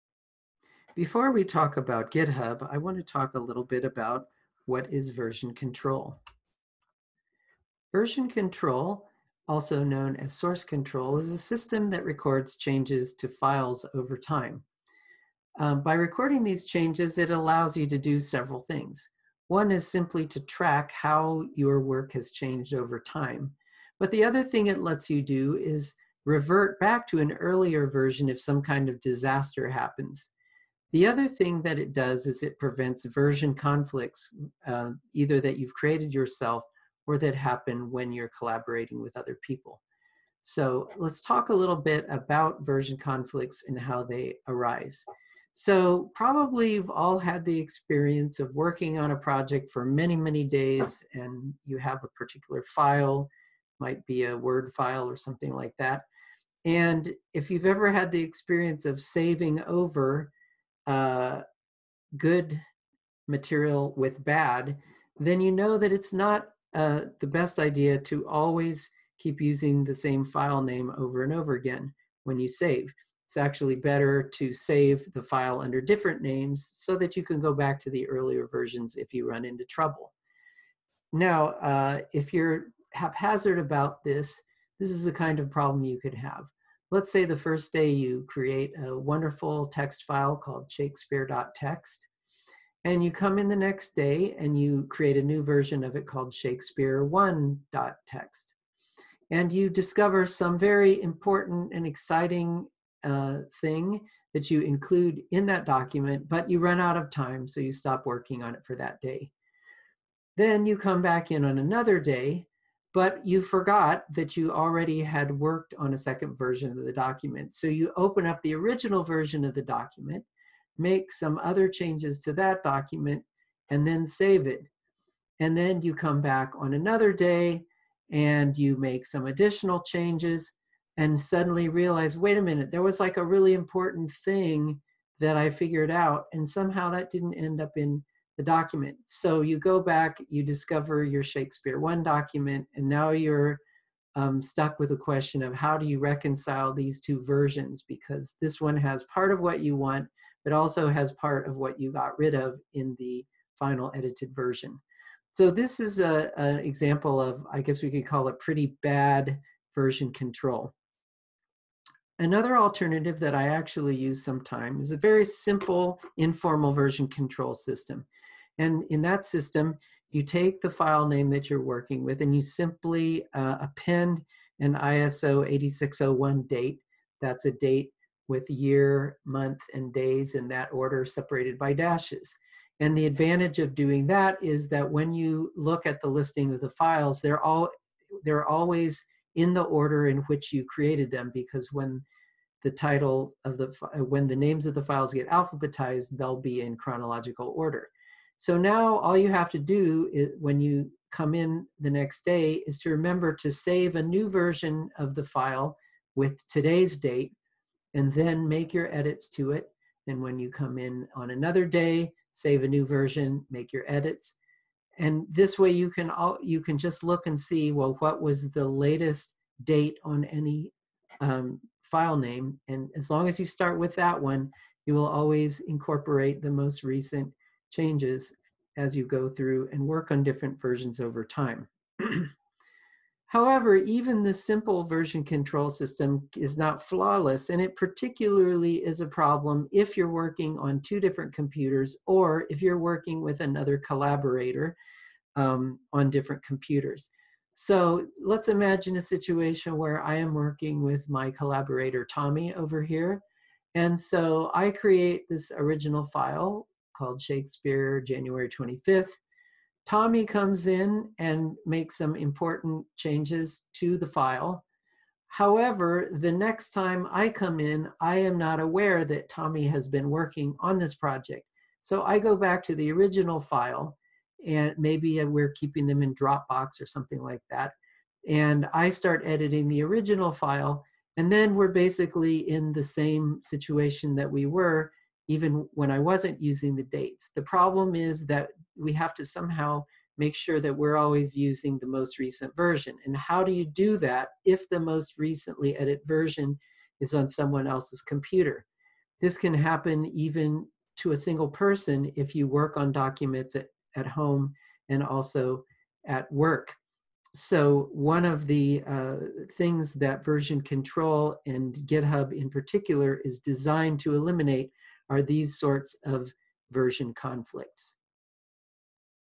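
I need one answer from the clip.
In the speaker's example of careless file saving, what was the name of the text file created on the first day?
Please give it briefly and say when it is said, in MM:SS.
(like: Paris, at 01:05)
Shakespeare.txt, at 01:30.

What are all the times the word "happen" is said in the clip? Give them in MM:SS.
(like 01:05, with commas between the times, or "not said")
00:29, 00:37, 04:59.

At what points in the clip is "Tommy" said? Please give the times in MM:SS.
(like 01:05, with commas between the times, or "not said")
04:12, 04:19, 04:29.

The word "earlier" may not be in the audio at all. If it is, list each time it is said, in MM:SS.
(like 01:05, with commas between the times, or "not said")
00:27, 01:18.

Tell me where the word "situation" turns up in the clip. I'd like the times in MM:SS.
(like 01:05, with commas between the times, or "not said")
04:09, 04:43.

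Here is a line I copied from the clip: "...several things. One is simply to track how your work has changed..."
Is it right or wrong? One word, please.
right.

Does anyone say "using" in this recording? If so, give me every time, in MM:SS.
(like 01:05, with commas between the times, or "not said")
01:09, 04:46, 04:51.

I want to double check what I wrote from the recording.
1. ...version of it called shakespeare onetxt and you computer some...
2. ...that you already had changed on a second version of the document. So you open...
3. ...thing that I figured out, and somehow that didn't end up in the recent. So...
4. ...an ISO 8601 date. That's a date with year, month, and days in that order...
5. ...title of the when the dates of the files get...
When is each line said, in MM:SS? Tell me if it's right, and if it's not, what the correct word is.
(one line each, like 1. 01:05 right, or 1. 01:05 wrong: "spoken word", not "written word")
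1. 01:35 wrong: "discover", not "computer"
2. 01:54 wrong: "worked", not "changed"
3. 02:14 wrong: "document", not "recent"
4. 02:54 right
5. 03:12 wrong: "names", not "dates".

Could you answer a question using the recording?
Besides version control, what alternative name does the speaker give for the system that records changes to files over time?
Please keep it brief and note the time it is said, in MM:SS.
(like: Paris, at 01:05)
source control, at 00:10.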